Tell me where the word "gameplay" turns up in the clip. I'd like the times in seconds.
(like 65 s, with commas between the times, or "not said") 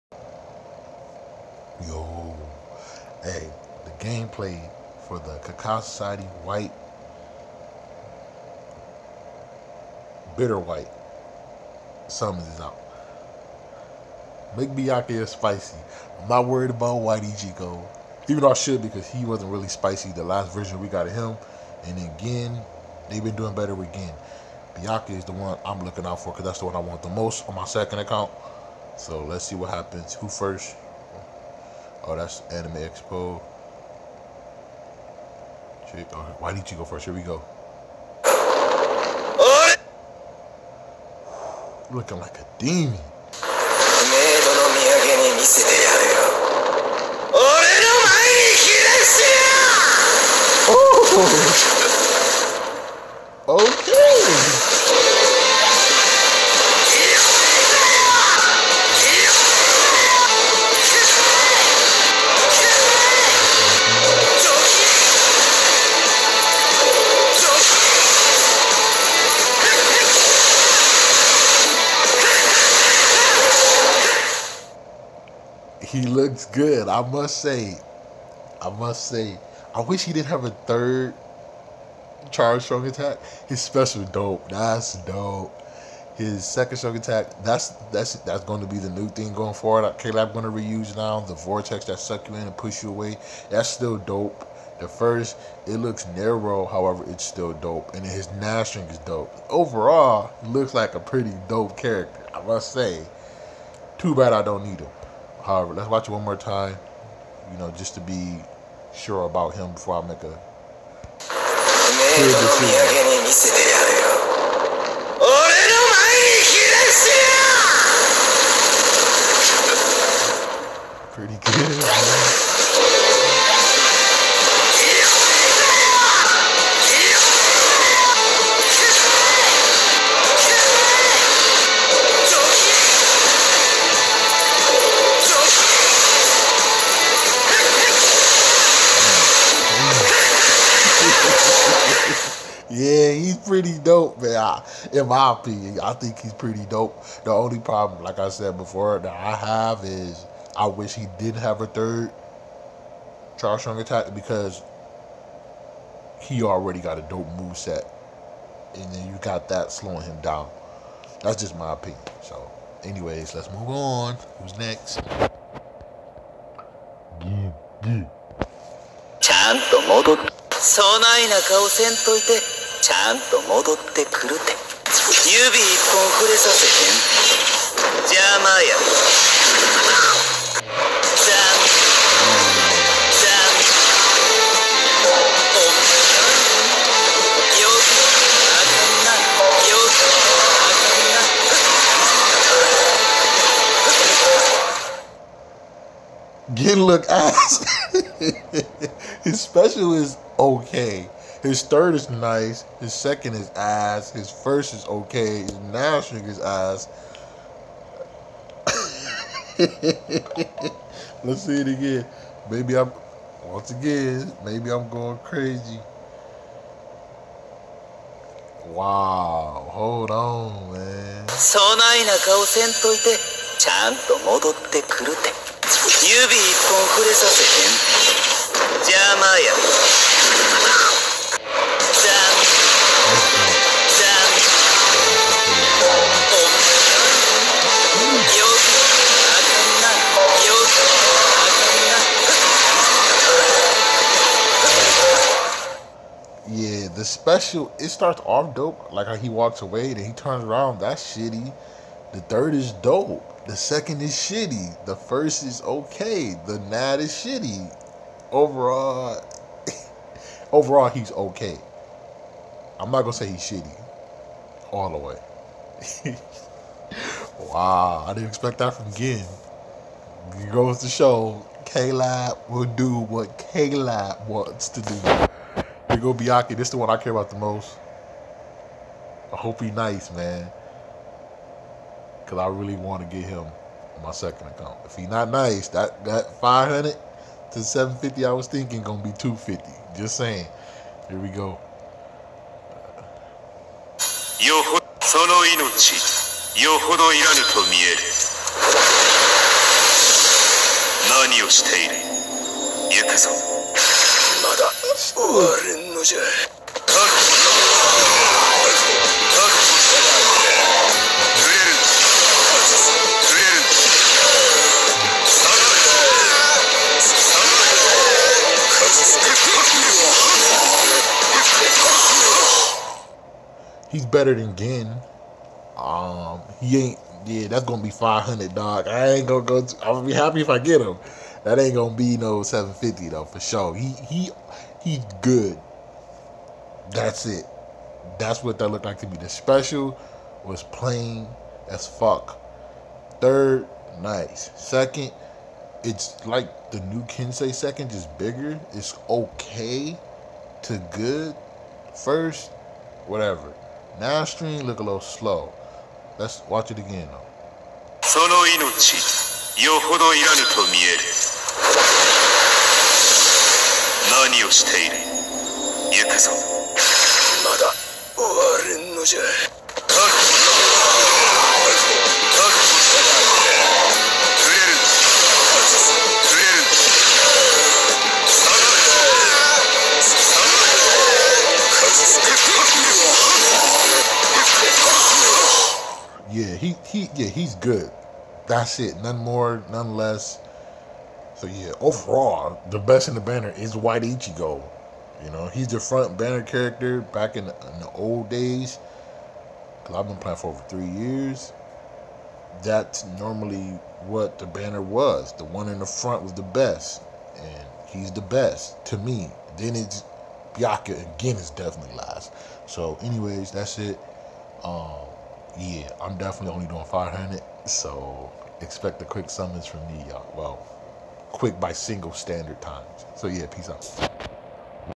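4 s.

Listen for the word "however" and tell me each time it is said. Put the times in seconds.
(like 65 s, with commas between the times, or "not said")
96 s, 105 s.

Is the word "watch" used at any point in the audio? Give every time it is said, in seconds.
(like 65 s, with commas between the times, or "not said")
105 s, 356 s.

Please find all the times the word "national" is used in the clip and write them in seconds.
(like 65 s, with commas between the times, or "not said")
205 s.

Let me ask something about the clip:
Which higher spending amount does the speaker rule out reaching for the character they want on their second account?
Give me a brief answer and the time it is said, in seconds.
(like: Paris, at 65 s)
750, at 332 s.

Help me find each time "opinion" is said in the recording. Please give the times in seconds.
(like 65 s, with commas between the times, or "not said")
145 s, 161 s.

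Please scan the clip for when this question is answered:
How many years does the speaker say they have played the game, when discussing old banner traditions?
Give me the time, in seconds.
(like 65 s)
400 s.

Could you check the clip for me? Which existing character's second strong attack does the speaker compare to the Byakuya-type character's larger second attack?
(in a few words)
Kensei.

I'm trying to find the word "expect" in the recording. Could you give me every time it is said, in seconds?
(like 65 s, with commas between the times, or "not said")
268 s, 418 s.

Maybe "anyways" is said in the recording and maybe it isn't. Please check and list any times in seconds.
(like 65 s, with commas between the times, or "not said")
162 s, 413 s.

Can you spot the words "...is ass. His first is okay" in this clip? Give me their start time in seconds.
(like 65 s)
203 s.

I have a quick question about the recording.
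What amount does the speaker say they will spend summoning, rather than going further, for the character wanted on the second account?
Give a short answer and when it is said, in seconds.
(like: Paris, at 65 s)
500, at 327 s.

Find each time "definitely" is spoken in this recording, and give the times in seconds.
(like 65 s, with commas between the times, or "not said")
411 s, 416 s.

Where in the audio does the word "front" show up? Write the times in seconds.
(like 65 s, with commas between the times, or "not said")
395 s, 405 s.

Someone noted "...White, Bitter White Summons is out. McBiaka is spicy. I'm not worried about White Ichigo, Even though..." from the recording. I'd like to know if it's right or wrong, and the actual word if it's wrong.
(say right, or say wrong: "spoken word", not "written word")
right.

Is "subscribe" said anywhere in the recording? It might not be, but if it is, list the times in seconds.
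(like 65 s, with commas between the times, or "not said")
not said.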